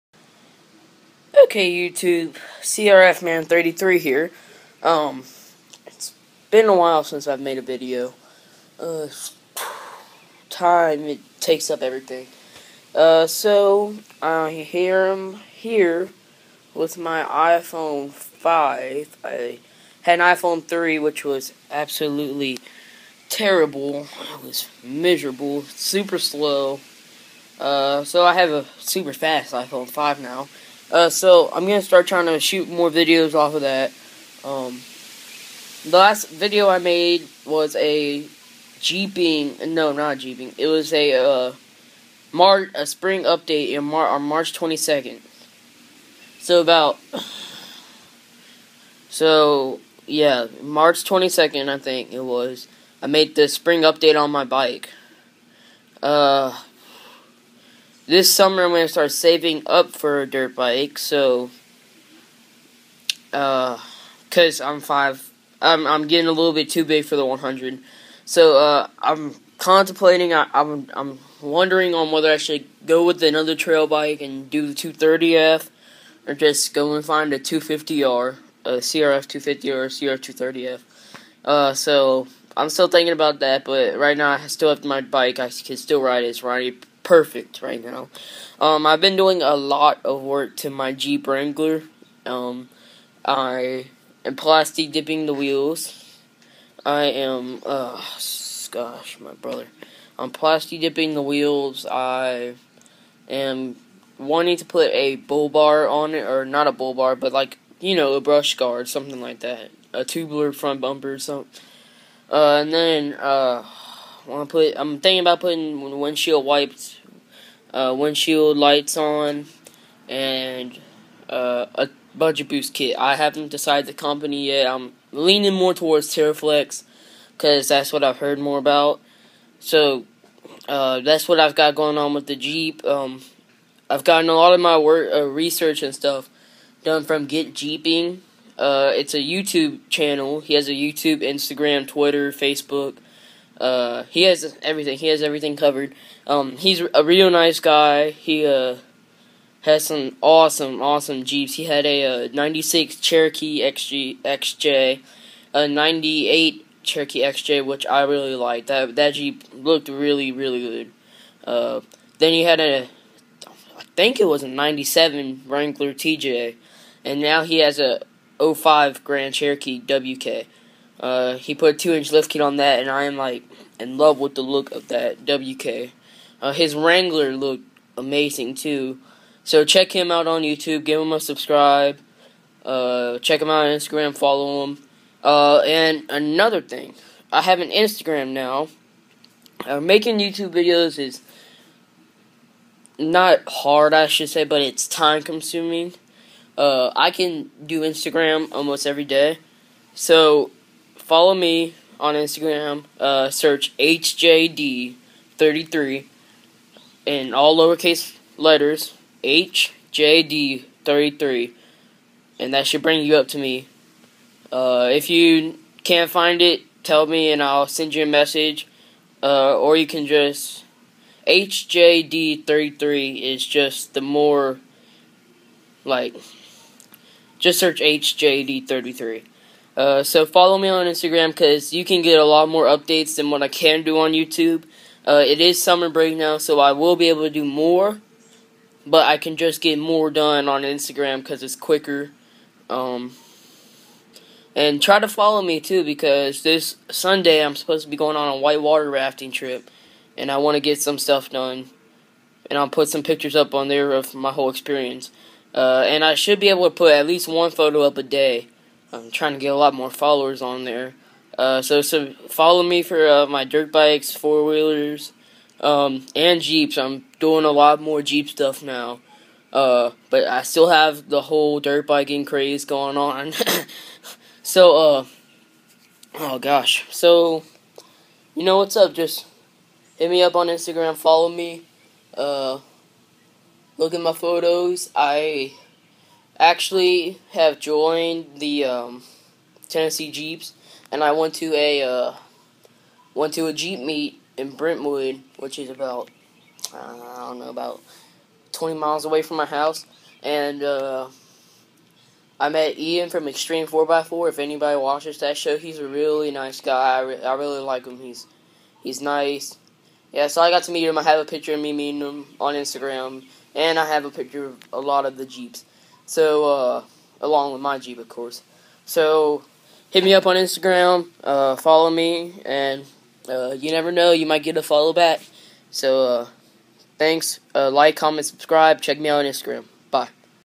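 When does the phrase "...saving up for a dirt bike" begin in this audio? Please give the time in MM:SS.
00:59.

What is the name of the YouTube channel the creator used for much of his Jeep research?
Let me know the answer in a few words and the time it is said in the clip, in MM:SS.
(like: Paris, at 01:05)
Get Jeeping, at 02:17.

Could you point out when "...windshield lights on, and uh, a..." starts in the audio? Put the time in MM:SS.
01:57.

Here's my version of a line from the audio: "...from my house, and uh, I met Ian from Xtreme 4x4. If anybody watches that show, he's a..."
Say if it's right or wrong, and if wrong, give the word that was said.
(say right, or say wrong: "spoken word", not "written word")
right.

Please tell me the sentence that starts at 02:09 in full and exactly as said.
So uh, that's what I've got going on with the Jeep.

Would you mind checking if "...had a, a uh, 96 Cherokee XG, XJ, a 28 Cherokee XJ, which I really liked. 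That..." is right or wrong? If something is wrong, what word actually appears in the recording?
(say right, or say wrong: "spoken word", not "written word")
wrong: "98", not "28".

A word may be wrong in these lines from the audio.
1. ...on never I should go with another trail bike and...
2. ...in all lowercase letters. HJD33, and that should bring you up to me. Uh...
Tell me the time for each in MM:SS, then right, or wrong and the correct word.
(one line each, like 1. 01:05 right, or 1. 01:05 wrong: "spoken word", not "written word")
1. 01:11 wrong: "whether", not "never"
2. 03:27 right.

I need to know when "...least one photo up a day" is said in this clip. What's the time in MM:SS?
04:17.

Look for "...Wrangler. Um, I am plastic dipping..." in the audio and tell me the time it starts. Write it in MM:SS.
01:31.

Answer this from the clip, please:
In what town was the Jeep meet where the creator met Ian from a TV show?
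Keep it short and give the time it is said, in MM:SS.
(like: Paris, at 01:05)
Brentwood, at 04:54.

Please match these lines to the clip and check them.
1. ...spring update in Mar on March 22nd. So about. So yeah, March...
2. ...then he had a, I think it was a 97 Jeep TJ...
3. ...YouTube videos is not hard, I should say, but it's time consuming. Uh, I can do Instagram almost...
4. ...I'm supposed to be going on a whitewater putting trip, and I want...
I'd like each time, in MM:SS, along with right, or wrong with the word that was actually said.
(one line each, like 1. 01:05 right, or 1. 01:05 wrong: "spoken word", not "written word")
1. 00:42 right
2. 02:42 wrong: "Wrangler", not "Jeep"
3. 03:10 right
4. 04:07 wrong: "rafting", not "putting".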